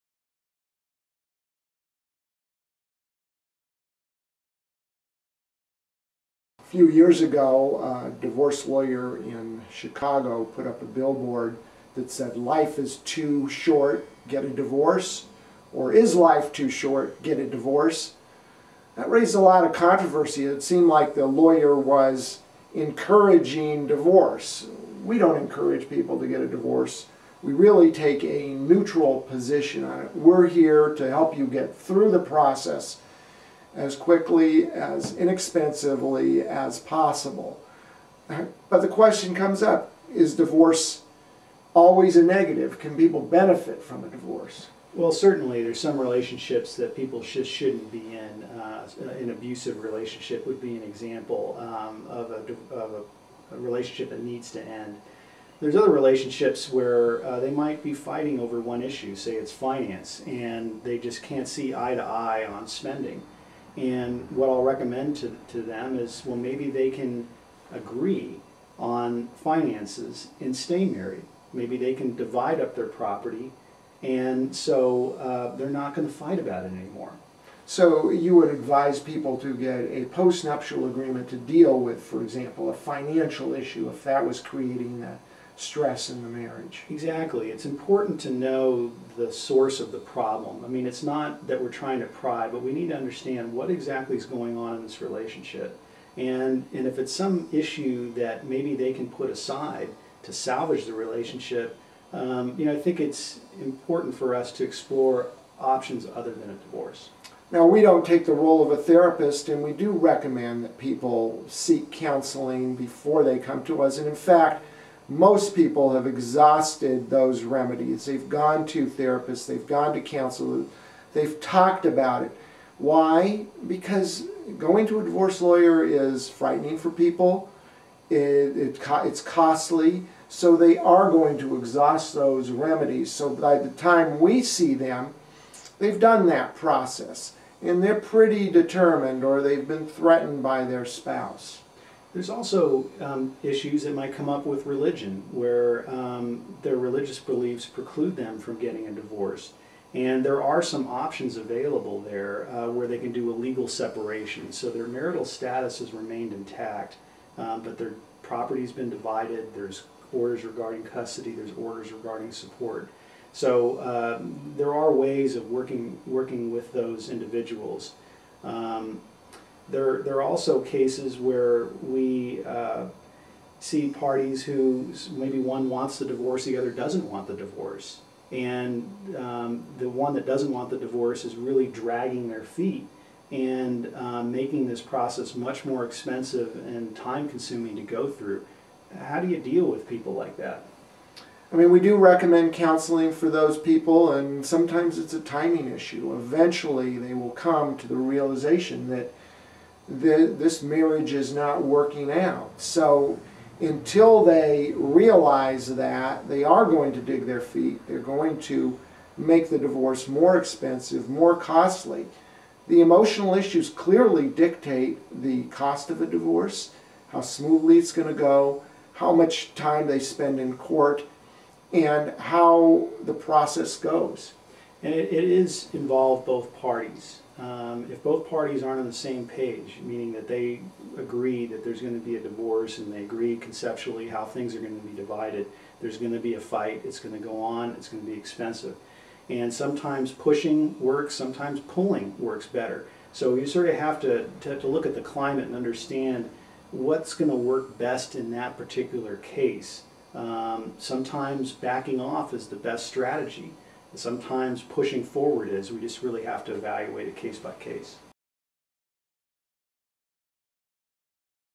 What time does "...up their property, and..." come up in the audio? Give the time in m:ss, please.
1:12.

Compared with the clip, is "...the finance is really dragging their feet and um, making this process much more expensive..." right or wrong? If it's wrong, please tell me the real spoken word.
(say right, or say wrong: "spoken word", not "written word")
wrong: "divorce", not "finance".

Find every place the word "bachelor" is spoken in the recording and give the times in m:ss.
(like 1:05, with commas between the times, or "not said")
not said.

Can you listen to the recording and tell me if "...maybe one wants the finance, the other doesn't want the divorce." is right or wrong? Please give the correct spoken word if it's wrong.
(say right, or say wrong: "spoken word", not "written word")
wrong: "divorce", not "finance".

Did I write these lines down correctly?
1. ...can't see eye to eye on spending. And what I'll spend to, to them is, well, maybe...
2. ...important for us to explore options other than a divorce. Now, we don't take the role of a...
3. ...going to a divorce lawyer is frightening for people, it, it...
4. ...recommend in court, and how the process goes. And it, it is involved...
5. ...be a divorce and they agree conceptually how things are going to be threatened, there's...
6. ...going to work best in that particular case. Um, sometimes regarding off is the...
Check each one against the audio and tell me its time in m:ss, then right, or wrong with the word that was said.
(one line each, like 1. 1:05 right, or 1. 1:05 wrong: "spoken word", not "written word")
1. 1:01 wrong: "recommend", not "spend"
2. 1:43 right
3. 2:04 right
4. 3:39 wrong: "spend", not "recommend"
5. 3:52 wrong: "divided", not "threatened"
6. 4:07 wrong: "backing", not "regarding".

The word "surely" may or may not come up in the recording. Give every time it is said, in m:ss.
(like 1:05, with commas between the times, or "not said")
not said.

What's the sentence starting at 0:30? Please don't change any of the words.
We're here to help you get through the process as quickly, as inexpensively as possible.